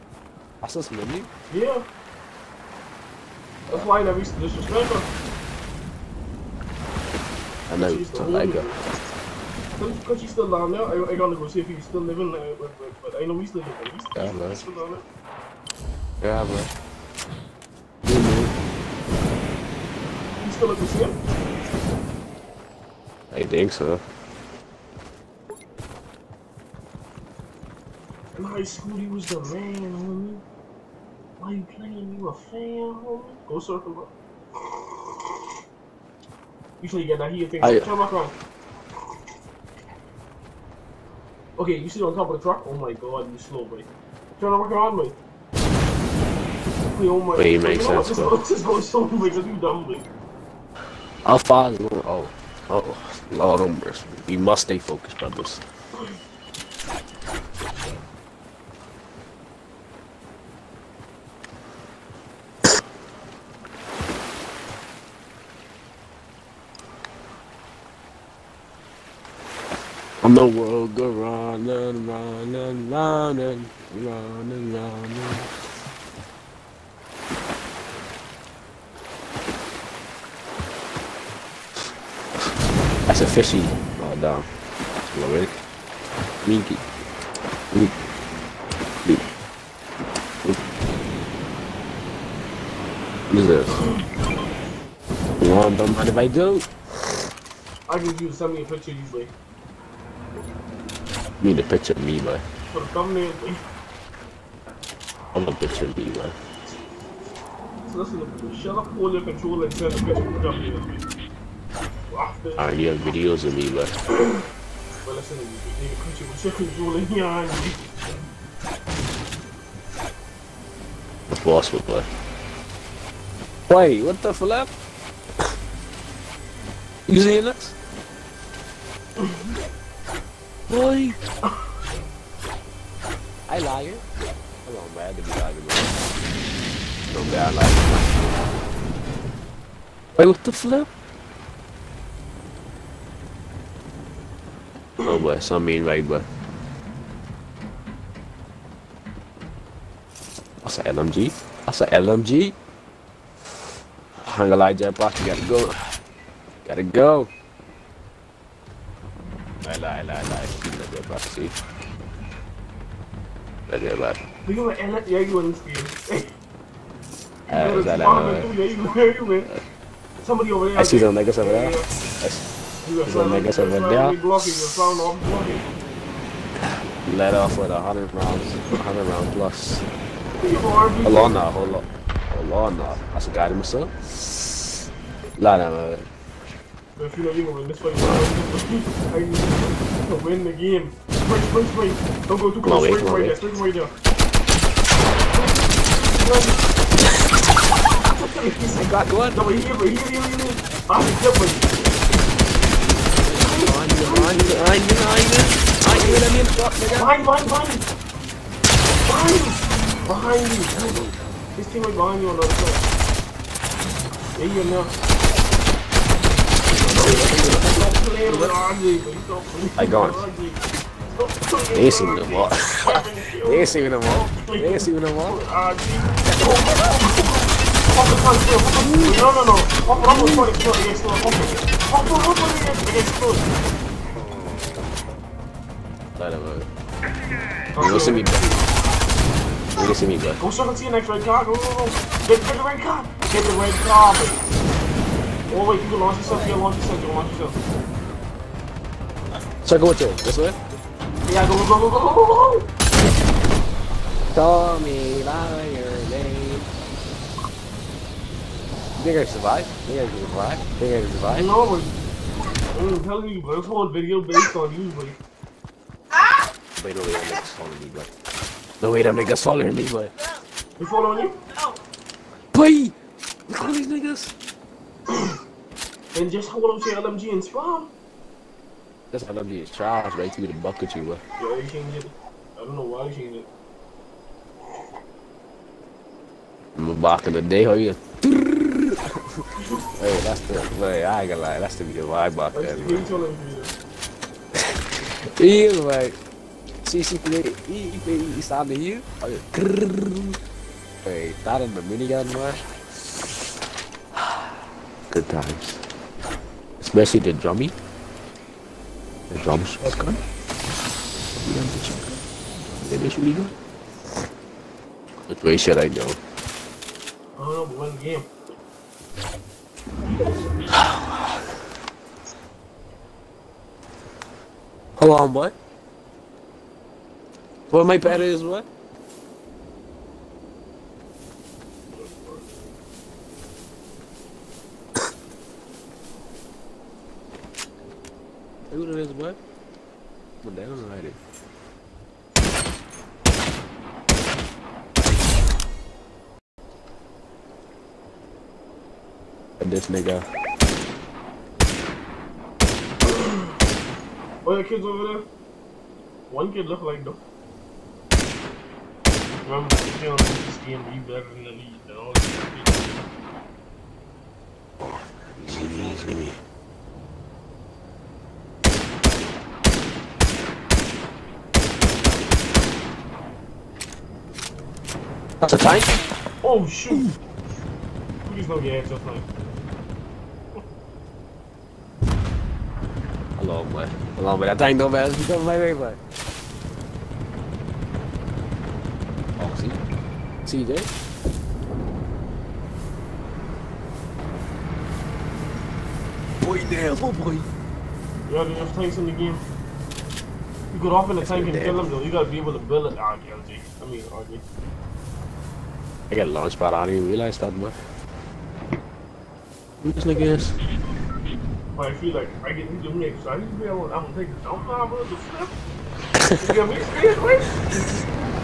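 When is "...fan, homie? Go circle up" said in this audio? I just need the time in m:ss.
0:32.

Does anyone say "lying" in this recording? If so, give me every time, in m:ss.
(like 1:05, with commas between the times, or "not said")
2:15.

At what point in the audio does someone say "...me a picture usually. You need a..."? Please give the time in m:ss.
1:38.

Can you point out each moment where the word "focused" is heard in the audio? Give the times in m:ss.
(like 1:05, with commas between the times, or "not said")
0:54.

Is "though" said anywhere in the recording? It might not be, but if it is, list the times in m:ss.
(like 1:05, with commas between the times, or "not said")
5:57, 6:41.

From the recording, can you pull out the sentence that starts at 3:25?
Aynen öyle bir Behind, behind, behind.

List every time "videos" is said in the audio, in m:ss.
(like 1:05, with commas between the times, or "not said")
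1:52, 4:23.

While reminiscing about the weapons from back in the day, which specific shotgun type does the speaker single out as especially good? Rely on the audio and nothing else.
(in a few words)
drum shotgun.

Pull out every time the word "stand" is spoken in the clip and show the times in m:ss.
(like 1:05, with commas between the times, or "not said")
4:58.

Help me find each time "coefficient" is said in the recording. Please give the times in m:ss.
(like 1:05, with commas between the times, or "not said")
not said.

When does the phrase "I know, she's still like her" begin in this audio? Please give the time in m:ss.
0:07.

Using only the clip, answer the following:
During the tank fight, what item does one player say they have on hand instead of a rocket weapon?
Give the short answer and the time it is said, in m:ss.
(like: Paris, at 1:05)
launch pad, at 6:46.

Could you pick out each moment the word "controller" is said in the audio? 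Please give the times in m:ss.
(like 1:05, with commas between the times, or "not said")
1:49.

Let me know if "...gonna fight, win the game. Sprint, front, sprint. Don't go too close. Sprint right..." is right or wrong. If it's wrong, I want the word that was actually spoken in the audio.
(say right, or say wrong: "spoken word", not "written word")
wrong: "sprint", not "front".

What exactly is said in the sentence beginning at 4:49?
Hey, that's the way I ain't gonna lie, that's the be I vibe that.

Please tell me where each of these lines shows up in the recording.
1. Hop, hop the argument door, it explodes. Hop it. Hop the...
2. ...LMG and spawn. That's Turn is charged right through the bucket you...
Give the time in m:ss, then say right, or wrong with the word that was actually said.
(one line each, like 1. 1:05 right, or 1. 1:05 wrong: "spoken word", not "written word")
1. 3:49 wrong: "front", not "argument"
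2. 4:37 wrong: "LMG", not "Turn".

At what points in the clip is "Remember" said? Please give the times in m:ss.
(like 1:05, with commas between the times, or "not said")
5:59.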